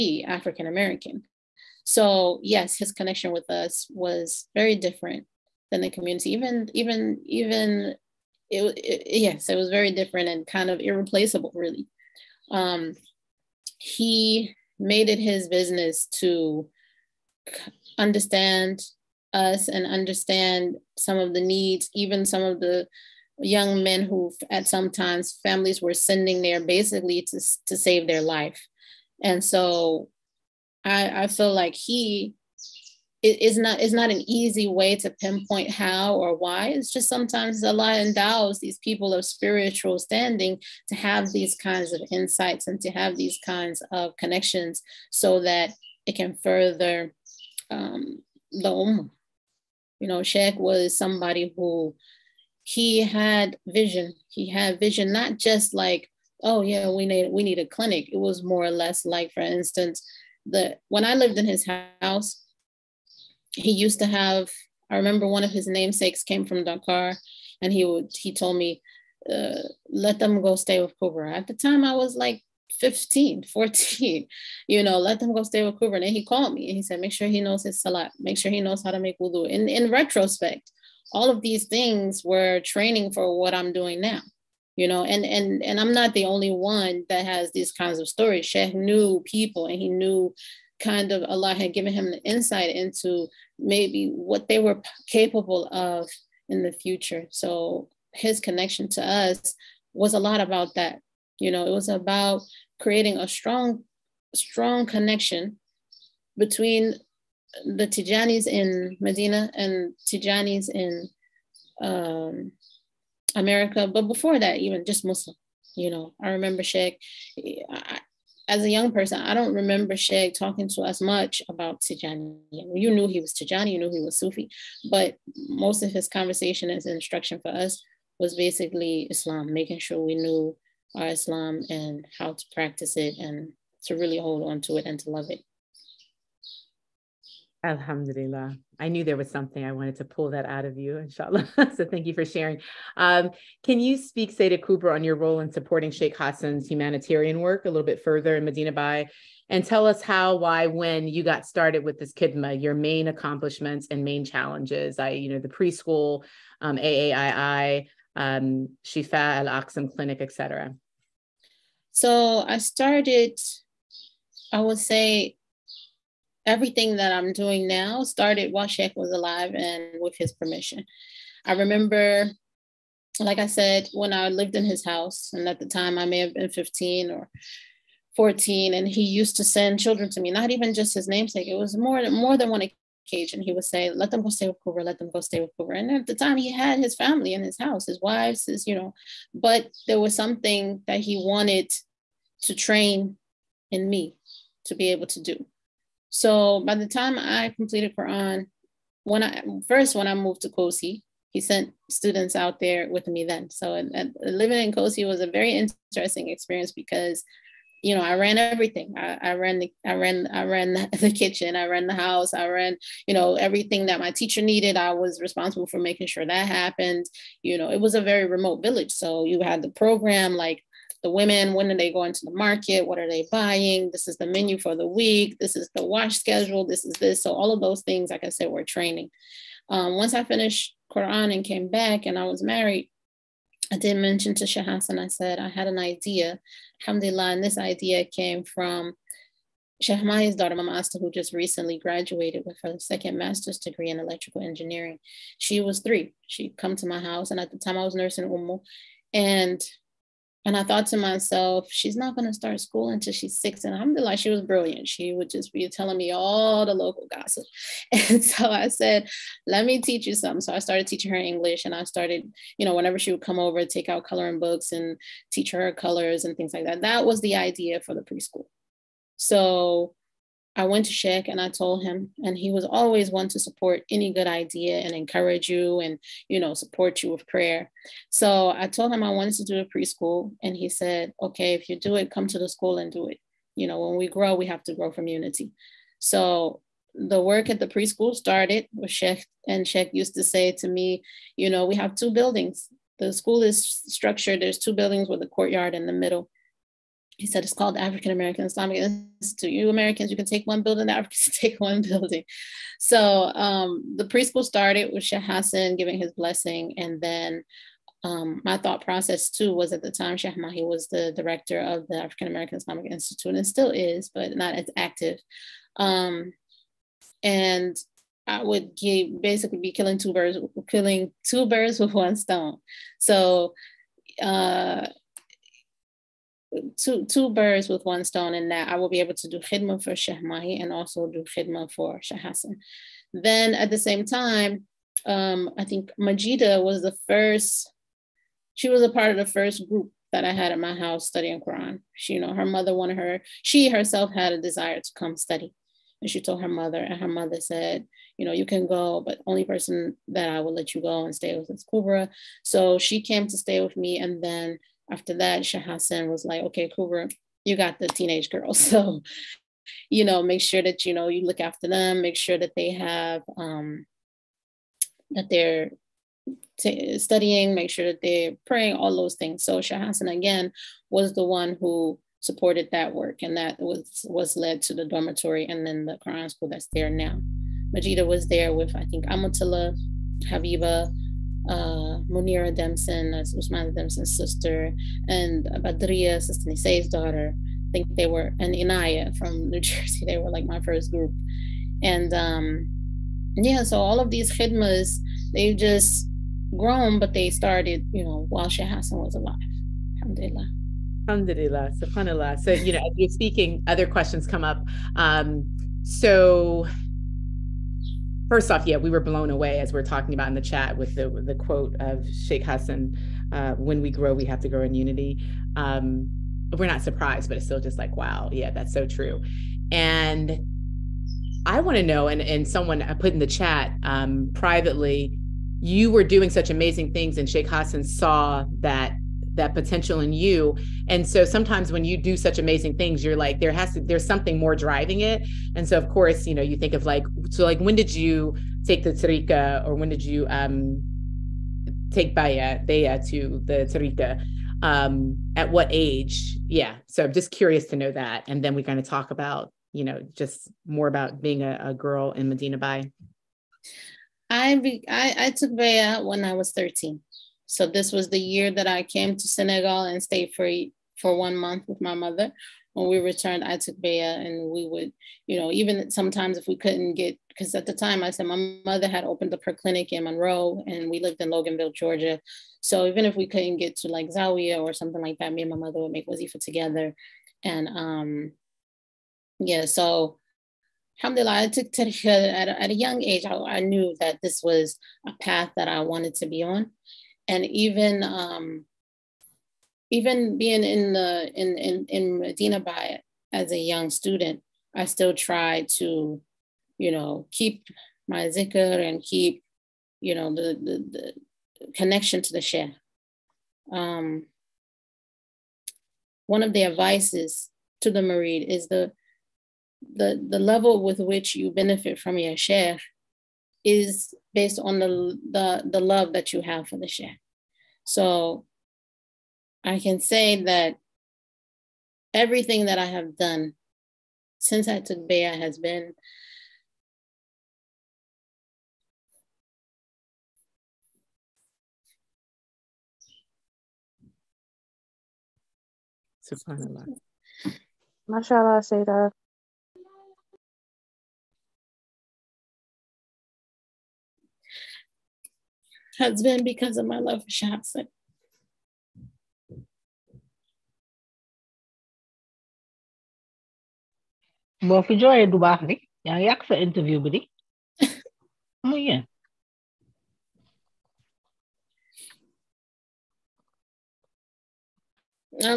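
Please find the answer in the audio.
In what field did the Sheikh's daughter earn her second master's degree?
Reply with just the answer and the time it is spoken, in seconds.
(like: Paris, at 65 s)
electrical engineering, at 244 s.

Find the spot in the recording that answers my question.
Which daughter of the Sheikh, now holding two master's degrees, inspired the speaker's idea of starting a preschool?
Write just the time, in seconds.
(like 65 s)
240 s.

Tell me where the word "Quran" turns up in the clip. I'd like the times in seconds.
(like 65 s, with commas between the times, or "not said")
197 s, 230 s, 341 s, 376 s.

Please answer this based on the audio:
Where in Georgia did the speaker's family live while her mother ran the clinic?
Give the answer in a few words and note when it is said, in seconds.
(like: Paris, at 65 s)
Loganville, at 471 s.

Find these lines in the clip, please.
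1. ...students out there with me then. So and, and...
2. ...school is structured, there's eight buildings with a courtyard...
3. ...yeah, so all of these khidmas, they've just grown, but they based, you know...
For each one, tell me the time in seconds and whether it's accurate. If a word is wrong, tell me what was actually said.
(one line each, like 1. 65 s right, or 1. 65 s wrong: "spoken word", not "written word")
1. 201 s right
2. 293 s wrong: "two", not "eight"
3. 393 s wrong: "started", not "based".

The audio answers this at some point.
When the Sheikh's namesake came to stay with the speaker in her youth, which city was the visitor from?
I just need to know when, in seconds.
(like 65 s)
66 s.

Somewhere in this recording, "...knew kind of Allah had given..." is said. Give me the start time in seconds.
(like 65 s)
89 s.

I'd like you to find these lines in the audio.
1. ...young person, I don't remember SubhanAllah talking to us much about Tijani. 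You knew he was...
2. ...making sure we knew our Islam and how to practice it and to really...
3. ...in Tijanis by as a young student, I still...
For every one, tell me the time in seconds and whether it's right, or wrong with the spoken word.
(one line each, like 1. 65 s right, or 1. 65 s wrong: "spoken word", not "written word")
1. 118 s wrong: "Shag", not "SubhanAllah"
2. 129 s right
3. 491 s wrong: "Medina", not "Tijanis".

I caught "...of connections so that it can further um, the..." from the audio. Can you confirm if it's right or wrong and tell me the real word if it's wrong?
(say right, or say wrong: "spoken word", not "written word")
right.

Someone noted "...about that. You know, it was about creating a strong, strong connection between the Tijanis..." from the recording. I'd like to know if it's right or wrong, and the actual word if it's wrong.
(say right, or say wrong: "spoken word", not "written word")
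right.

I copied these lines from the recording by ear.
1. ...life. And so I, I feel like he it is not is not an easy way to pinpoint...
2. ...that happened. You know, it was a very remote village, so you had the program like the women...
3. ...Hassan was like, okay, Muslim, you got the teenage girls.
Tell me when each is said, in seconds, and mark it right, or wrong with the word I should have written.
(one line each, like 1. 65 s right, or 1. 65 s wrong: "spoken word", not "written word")
1. 28 s right
2. 216 s right
3. 355 s wrong: "Kubra", not "Muslim".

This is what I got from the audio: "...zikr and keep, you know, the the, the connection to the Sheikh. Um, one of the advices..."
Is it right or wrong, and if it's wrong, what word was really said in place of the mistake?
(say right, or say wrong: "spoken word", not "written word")
right.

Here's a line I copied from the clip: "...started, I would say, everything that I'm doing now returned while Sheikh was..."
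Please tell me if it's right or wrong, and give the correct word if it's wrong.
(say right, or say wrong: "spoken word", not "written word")
wrong: "started", not "returned".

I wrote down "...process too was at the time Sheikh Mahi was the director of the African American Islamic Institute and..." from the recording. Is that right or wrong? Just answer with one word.
right.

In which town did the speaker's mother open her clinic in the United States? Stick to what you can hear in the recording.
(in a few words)
Monroe.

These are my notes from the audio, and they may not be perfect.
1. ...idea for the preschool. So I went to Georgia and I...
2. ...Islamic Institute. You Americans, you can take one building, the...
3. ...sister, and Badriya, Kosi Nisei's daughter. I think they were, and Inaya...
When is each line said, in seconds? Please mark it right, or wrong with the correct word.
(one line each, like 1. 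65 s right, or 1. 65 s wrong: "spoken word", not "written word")
1. 267 s wrong: "Sheikh", not "Georgia"
2. 298 s right
3. 384 s wrong: "Sister", not "Kosi".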